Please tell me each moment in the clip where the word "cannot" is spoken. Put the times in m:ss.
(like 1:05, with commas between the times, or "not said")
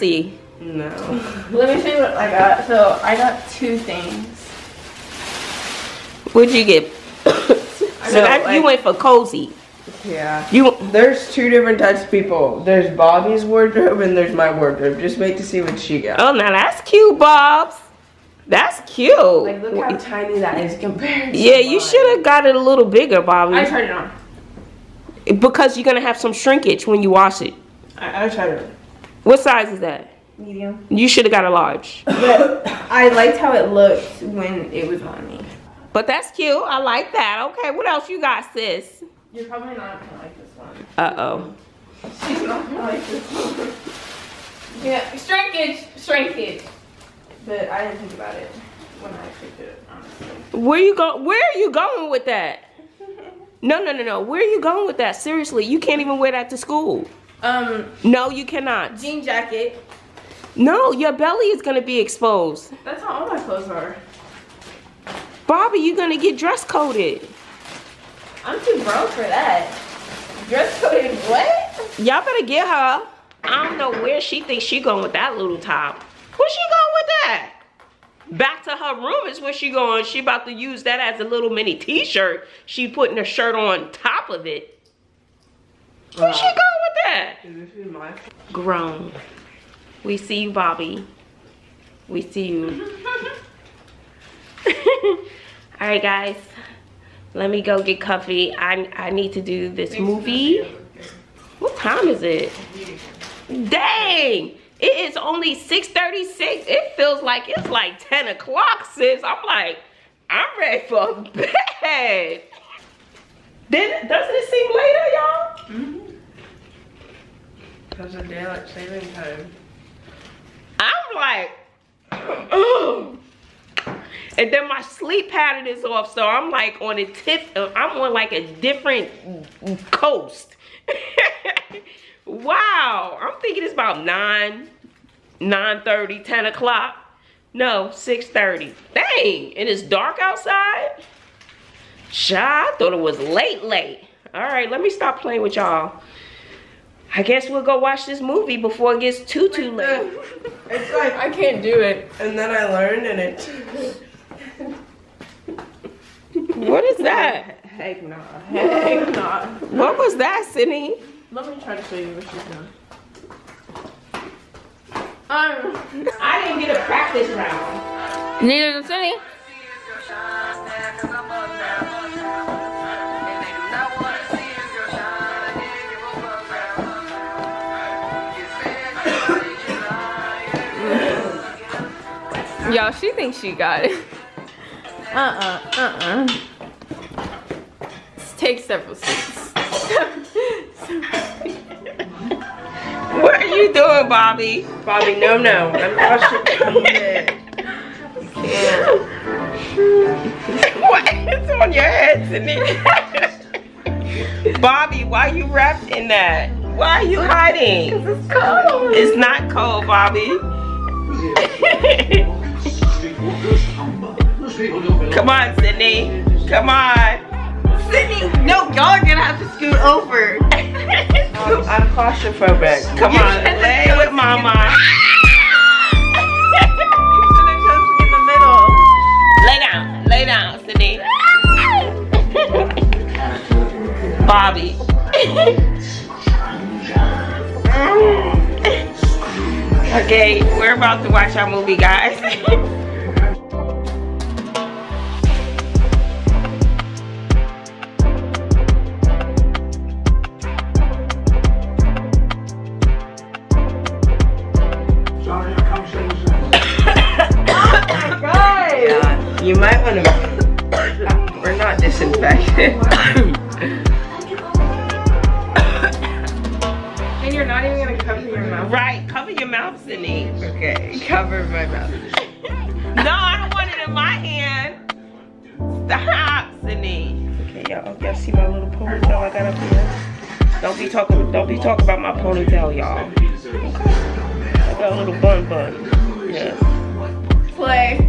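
0:58.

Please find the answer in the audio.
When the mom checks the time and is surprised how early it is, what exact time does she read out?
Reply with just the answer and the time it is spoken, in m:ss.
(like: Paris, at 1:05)
6:36, at 1:45.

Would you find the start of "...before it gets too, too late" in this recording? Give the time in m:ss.
2:28.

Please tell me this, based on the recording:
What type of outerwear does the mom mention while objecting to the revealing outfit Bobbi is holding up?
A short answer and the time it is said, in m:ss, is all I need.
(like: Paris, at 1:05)
Jean jacket, at 0:58.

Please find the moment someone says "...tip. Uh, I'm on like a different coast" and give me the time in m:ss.
2:07.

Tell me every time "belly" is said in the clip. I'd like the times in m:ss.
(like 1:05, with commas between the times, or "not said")
1:01.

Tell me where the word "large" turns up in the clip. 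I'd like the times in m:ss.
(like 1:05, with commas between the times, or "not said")
0:31.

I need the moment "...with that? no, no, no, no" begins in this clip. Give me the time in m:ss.
0:52.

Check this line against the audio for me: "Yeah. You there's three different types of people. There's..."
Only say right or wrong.
wrong.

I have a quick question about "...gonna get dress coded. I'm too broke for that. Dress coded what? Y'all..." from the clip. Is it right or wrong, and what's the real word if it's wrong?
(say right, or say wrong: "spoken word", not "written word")
right.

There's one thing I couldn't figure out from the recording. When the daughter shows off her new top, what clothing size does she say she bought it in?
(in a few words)
medium.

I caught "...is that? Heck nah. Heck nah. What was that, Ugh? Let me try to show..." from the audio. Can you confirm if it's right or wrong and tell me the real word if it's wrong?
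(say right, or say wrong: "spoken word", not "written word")
wrong: "Sydni", not "Ugh".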